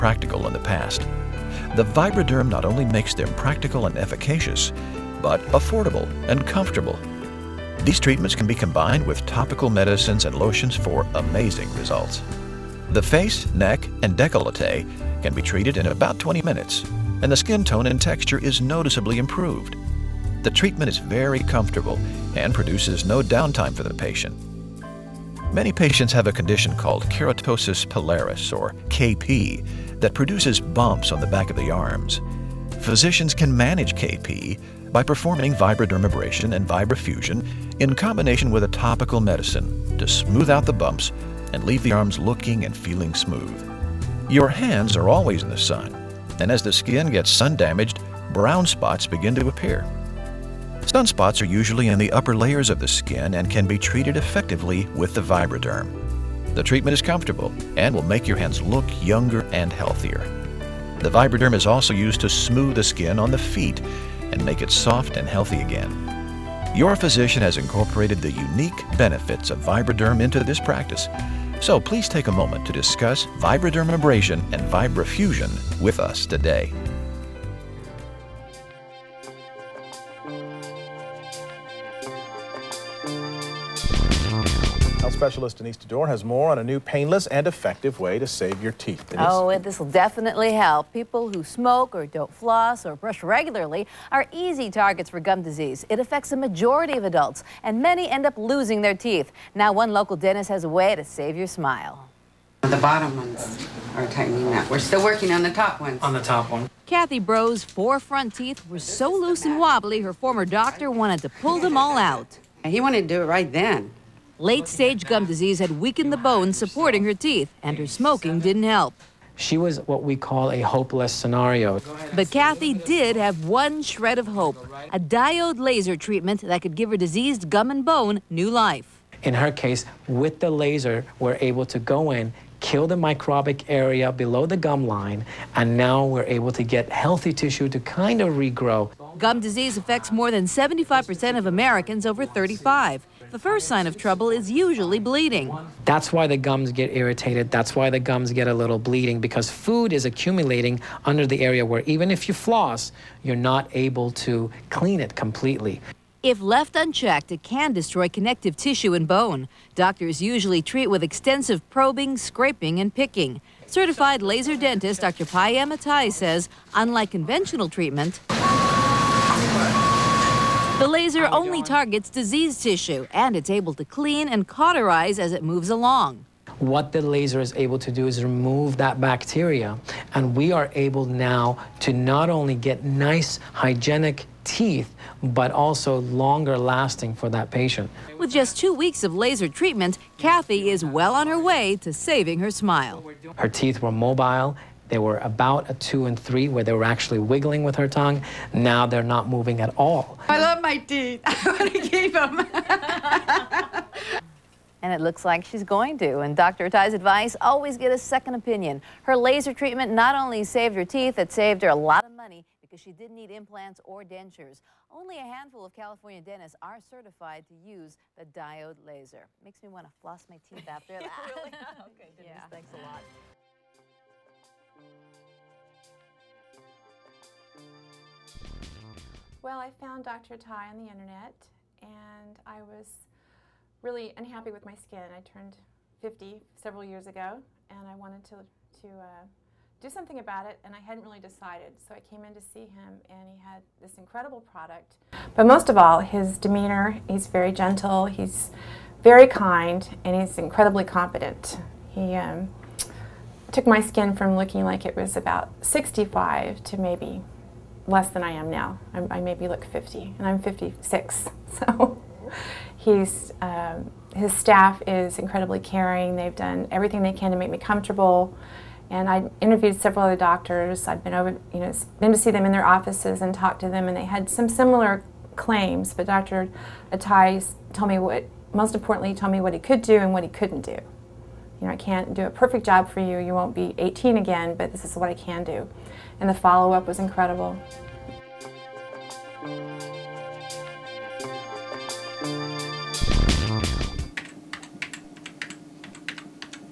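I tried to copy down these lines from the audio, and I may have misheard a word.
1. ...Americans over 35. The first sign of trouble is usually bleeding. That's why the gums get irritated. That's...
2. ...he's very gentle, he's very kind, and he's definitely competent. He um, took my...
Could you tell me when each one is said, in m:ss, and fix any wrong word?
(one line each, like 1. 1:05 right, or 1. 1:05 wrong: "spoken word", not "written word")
1. 2:21 right
2. 4:07 wrong: "incredibly", not "definitely".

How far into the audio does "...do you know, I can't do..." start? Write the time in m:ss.
4:40.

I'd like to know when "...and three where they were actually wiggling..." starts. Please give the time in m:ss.
3:16.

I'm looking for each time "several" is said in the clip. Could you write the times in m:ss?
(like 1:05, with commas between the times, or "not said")
3:56, 4:29.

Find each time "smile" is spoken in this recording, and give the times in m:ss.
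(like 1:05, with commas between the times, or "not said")
1:41, 3:12.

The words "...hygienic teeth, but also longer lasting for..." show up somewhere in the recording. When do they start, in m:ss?
3:03.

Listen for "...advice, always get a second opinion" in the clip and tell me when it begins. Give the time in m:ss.
3:26.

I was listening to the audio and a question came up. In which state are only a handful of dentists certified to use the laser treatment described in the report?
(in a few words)
California.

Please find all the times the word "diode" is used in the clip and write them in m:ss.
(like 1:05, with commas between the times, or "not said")
2:04, 3:38.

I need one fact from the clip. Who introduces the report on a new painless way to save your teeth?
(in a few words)
Denise Dador.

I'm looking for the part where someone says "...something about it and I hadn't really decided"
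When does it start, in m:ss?
3:59.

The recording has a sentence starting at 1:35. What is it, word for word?
It affects a majority of adults, and many end up losing their teeth.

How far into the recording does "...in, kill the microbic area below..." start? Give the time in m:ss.
2:12.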